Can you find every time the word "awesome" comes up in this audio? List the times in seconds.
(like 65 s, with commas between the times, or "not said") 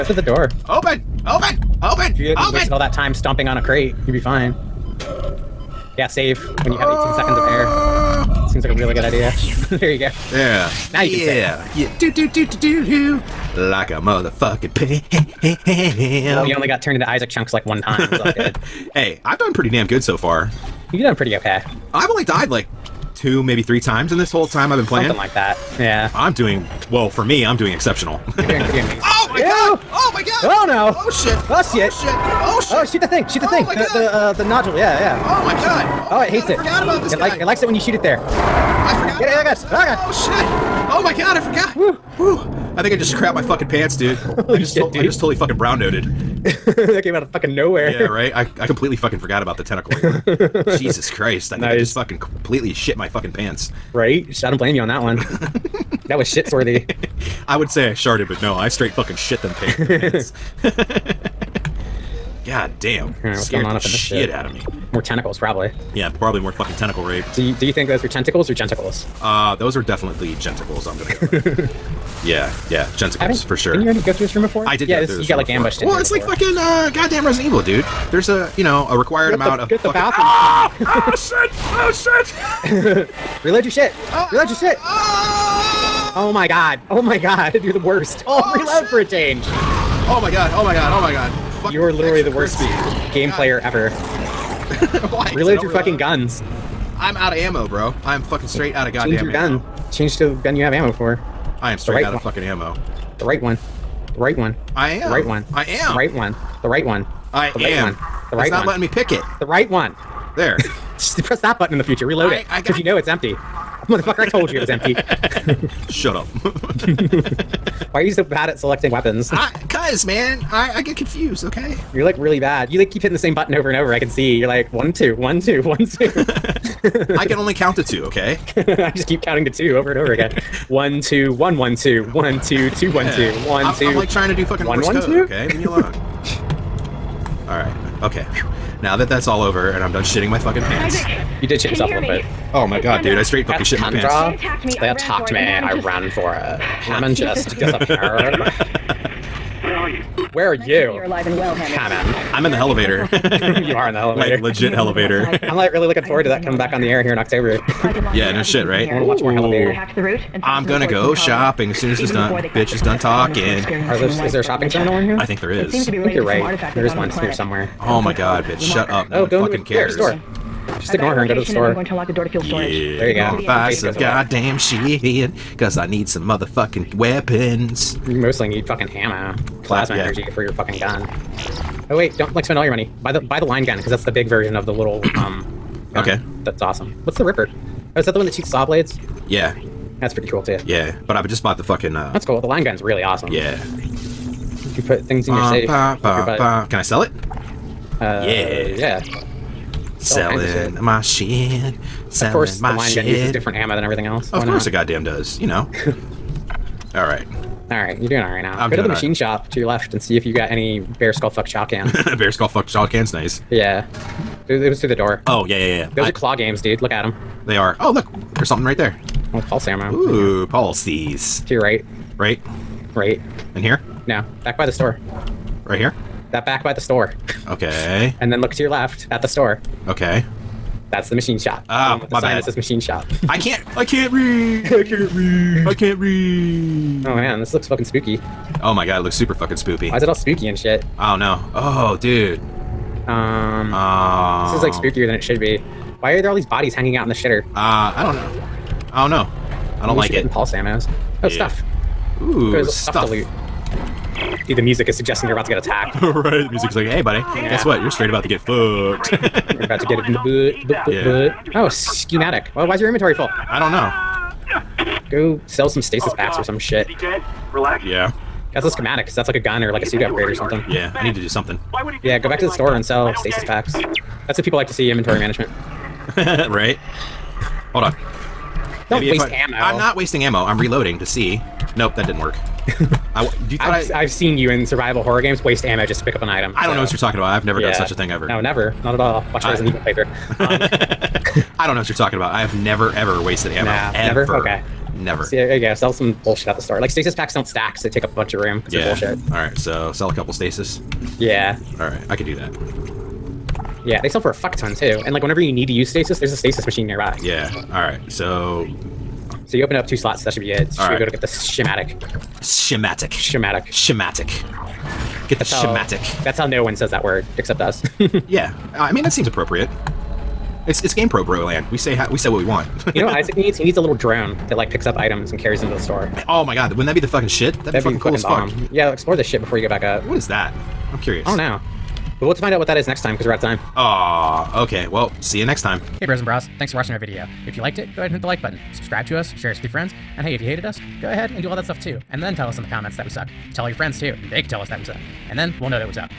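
186 s, 193 s.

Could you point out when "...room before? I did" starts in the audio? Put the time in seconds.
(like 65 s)
74 s.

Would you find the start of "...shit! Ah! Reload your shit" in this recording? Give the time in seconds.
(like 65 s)
83 s.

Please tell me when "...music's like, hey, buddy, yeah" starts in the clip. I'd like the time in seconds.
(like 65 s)
256 s.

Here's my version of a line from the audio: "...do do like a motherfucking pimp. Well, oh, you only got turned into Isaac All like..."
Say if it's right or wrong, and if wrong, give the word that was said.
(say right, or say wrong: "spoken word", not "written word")
wrong: "Chunks", not "All".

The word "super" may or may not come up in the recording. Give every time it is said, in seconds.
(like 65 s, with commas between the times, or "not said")
239 s.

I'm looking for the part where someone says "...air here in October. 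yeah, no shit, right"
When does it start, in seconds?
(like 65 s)
156 s.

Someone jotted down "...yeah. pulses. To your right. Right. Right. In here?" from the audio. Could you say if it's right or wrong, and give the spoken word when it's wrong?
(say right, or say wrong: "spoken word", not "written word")
right.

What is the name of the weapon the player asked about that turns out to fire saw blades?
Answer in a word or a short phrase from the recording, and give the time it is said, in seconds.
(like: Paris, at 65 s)
the Ripper, at 187 s.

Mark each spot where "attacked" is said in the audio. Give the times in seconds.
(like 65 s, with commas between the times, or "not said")
144 s, 255 s.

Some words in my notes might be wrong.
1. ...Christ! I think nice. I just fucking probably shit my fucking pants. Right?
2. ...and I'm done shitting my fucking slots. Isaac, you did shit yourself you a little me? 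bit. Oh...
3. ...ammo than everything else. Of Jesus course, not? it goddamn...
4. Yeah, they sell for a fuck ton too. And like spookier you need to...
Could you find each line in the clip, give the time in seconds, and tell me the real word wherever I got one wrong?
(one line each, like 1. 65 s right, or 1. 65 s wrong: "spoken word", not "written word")
1. 51 s wrong: "completely", not "probably"
2. 139 s wrong: "pants", not "slots"
3. 203 s wrong: "Why", not "Jesus"
4. 303 s wrong: "whenever", not "spookier".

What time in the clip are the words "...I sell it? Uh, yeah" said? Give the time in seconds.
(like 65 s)
196 s.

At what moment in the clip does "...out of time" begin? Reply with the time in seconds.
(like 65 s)
333 s.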